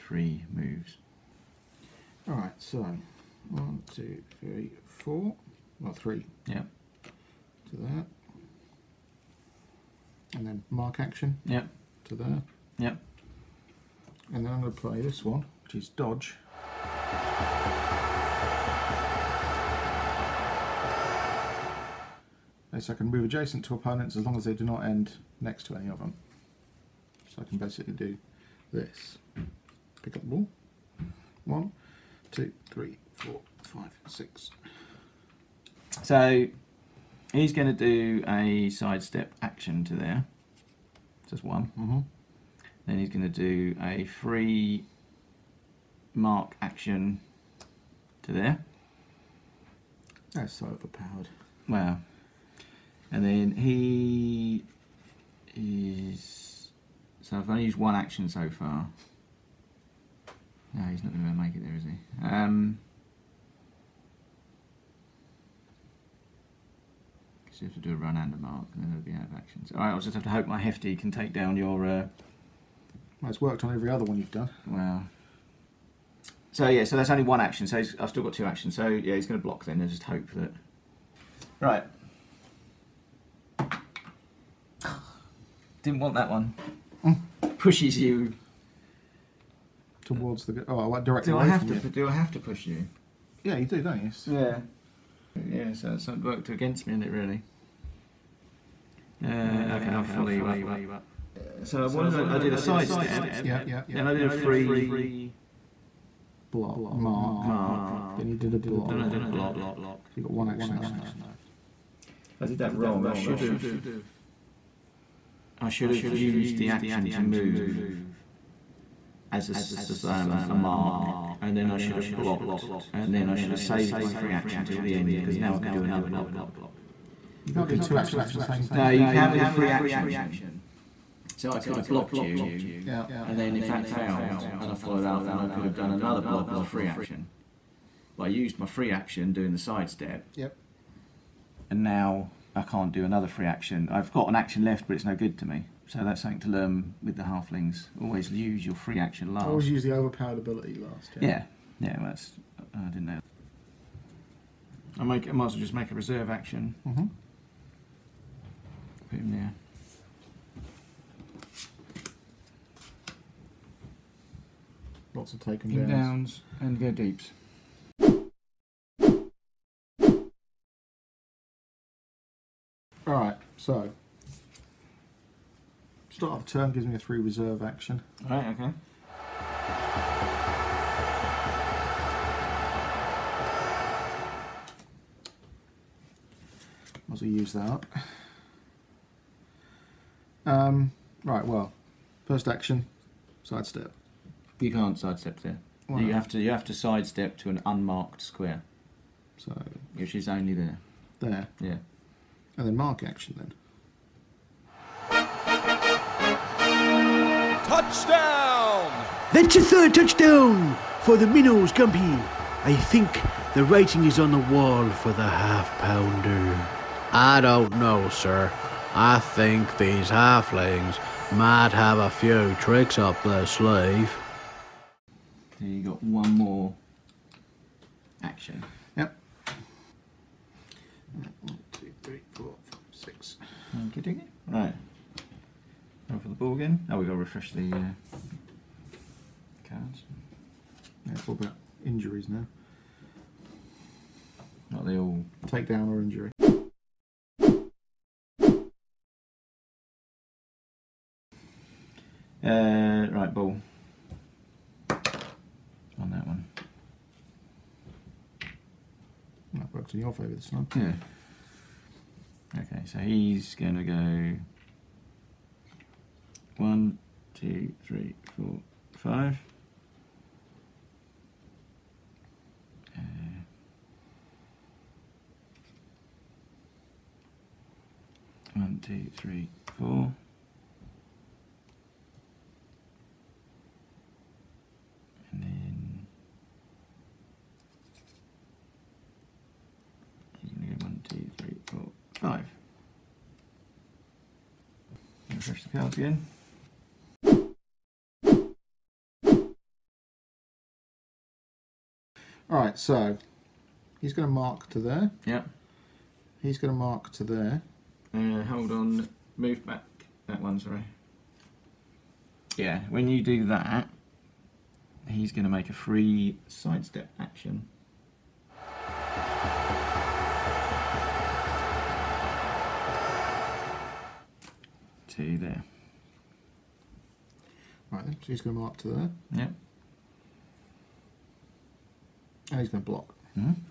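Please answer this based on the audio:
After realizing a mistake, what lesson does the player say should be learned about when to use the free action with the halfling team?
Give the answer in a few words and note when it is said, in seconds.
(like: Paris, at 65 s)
Always use your free action last, at 148 s.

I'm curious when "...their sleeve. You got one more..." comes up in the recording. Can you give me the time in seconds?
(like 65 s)
223 s.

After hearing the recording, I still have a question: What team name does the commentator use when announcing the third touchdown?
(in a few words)
Minnows.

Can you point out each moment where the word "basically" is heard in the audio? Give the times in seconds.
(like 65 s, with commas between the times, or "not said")
27 s.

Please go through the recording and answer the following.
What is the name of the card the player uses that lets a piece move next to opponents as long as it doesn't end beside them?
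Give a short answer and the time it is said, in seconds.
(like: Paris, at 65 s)
Dodge, at 15 s.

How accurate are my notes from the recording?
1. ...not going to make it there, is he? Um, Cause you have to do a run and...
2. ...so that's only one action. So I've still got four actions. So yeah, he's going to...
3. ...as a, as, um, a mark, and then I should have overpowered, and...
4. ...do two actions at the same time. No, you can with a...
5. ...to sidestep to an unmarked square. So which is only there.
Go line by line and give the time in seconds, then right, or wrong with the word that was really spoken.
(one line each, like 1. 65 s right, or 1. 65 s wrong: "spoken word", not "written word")
1. 61 s right
2. 76 s wrong: "two", not "four"
3. 119 s wrong: "blocked", not "overpowered"
4. 127 s right
5. 196 s right.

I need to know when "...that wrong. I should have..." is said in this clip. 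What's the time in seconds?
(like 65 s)
112 s.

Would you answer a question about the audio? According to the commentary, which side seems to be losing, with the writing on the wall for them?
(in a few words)
The half pounder.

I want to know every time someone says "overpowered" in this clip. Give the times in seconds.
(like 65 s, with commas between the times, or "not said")
50 s, 149 s.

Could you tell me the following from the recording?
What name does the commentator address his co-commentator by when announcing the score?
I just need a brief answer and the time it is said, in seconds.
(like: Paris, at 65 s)
Gumpy, at 211 s.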